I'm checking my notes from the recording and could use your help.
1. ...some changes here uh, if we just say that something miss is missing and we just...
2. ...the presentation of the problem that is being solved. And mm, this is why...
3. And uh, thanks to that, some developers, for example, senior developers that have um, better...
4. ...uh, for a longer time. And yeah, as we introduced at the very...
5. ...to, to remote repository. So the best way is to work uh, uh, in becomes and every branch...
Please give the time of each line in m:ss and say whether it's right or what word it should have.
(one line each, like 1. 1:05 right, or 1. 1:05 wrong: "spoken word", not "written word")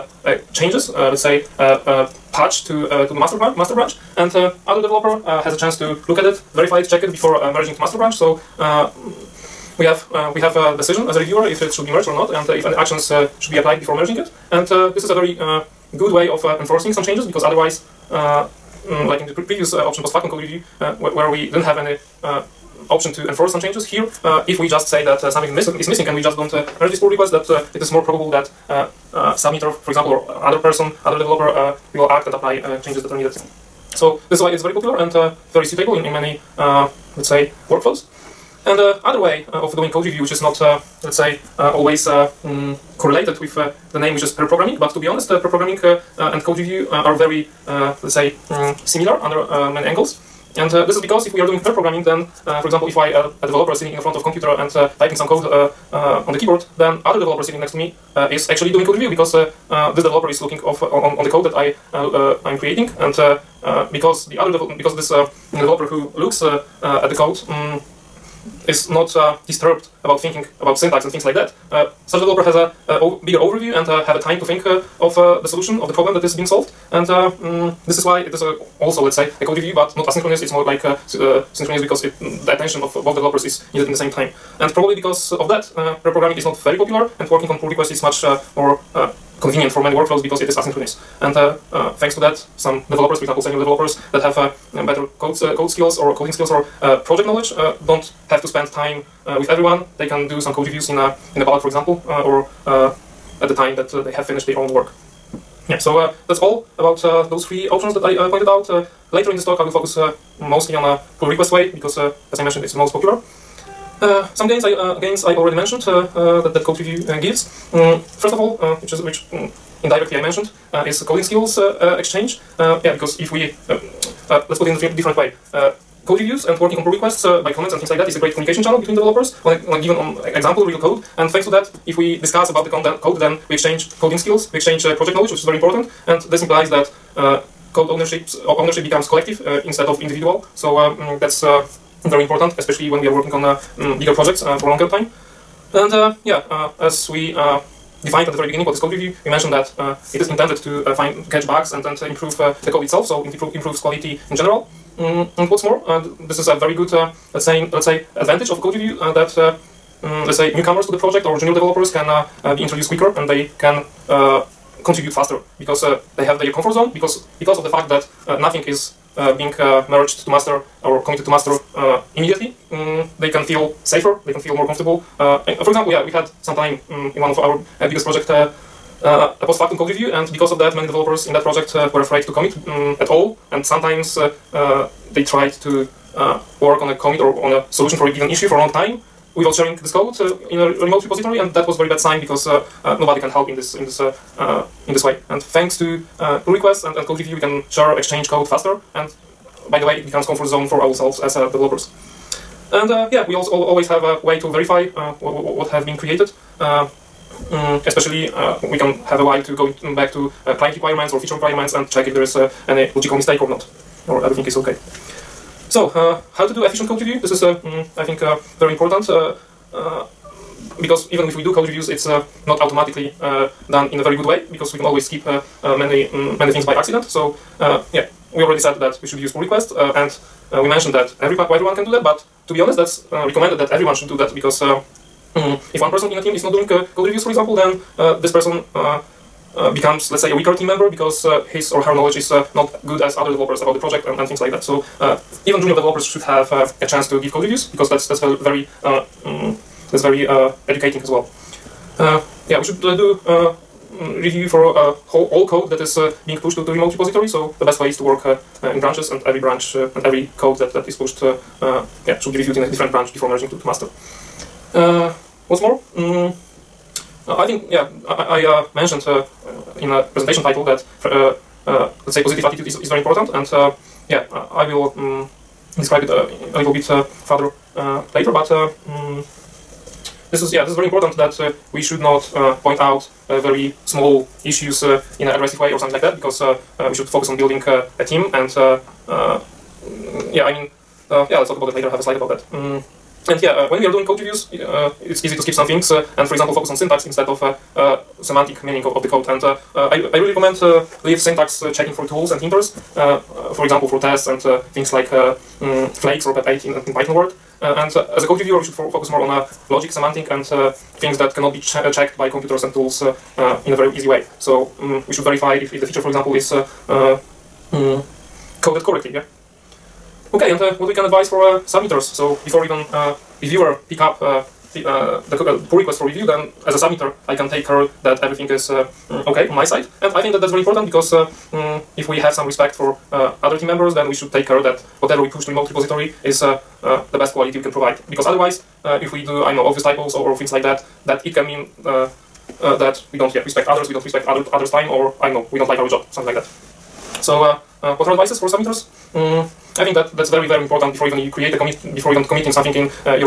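1. 0:23 right
2. 1:15 wrong: "solution", not "presentation"
3. 1:31 right
4. 2:24 wrong: "defined", not "introduced"
5. 4:16 wrong: "branches", not "becomes".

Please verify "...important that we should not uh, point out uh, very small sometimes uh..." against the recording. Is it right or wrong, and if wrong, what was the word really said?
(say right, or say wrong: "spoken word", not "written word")
wrong: "issues", not "sometimes".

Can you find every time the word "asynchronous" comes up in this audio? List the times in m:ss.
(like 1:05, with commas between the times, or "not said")
1:20, 1:30.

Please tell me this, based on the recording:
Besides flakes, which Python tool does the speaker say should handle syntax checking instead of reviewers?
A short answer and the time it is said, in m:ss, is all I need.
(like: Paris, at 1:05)
pep8, at 5:06.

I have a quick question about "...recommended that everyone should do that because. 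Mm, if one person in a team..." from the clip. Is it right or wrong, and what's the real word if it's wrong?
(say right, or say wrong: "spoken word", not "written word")
right.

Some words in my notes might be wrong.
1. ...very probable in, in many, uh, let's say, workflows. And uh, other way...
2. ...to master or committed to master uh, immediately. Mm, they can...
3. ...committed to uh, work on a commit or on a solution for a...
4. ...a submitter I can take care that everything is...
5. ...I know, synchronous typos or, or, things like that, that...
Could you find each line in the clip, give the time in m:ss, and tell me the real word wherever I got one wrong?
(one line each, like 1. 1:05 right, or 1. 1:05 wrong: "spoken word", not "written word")
1. 0:35 wrong: "suitable", not "probable"
2. 2:50 right
3. 3:05 wrong: "tried", not "committed"
4. 5:26 right
5. 5:39 wrong: "obvious", not "synchronous".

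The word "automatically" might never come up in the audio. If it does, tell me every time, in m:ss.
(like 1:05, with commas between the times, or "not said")
3:42.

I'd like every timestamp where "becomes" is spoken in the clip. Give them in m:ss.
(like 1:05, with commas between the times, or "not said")
2:18, 3:20, 3:59.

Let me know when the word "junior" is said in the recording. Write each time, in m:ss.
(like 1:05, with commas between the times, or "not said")
2:41, 4:05.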